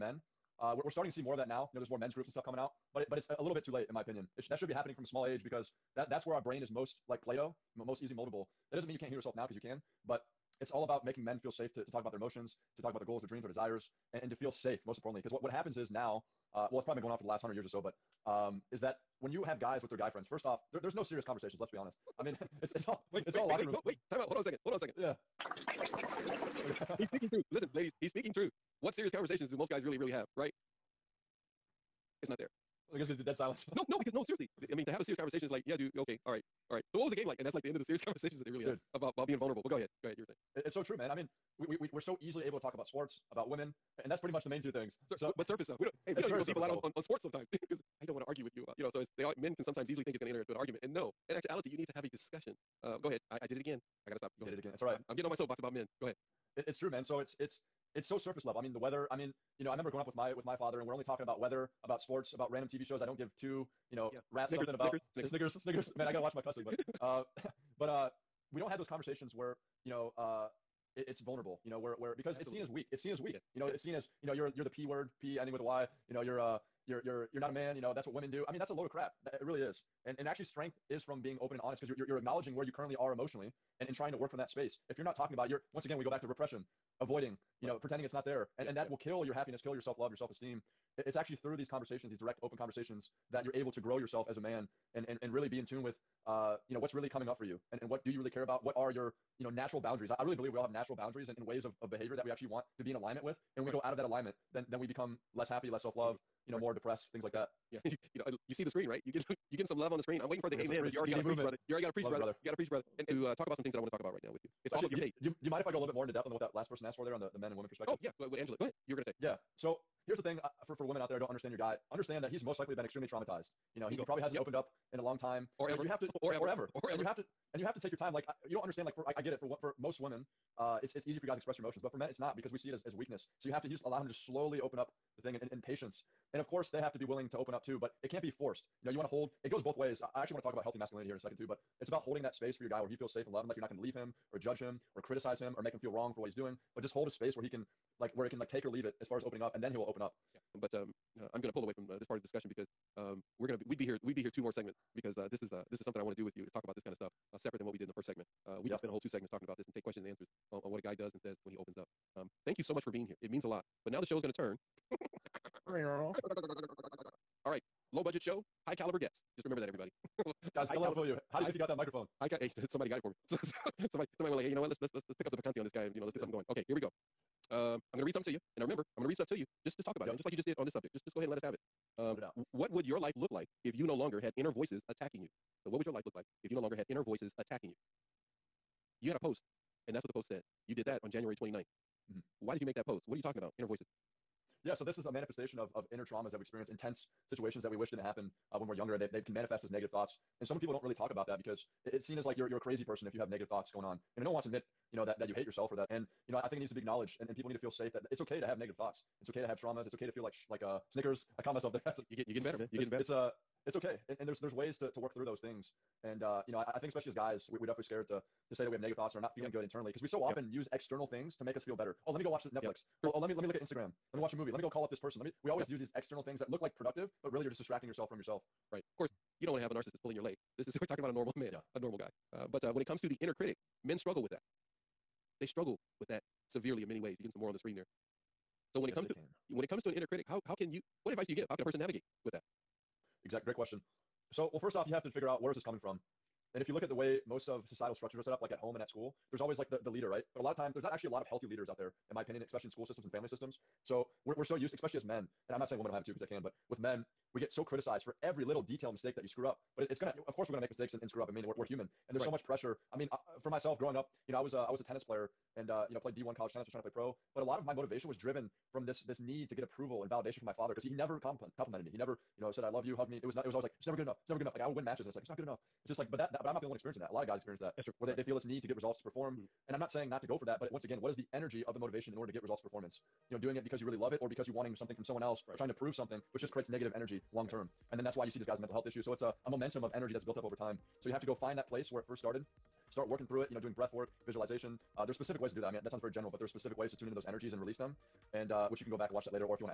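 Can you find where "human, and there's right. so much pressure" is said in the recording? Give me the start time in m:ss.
4:21.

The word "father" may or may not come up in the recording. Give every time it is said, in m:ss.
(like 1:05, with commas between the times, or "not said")
1:00, 4:30.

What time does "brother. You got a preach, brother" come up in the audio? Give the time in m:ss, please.
1:52.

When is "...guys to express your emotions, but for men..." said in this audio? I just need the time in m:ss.
2:11.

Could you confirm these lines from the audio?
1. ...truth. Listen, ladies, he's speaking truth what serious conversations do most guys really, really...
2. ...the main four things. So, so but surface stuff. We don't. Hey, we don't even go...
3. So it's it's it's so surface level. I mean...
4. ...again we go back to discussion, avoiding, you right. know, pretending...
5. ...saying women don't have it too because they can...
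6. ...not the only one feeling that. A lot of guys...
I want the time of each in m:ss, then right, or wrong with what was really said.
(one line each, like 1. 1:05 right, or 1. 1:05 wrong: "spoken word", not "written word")
1. 0:27 right
2. 0:44 wrong: "two", not "four"
3. 0:57 right
4. 1:25 wrong: "repression", not "discussion"
5. 4:15 right
6. 4:36 wrong: "experiencing", not "feeling".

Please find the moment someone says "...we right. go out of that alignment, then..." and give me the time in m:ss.
1:43.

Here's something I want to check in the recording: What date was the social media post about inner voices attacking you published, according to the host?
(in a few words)
January 29th.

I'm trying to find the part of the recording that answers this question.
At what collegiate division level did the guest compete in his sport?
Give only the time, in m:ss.
4:26.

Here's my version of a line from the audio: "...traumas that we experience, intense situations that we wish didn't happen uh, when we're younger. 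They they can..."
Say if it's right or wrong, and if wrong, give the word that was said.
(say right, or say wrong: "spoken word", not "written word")
right.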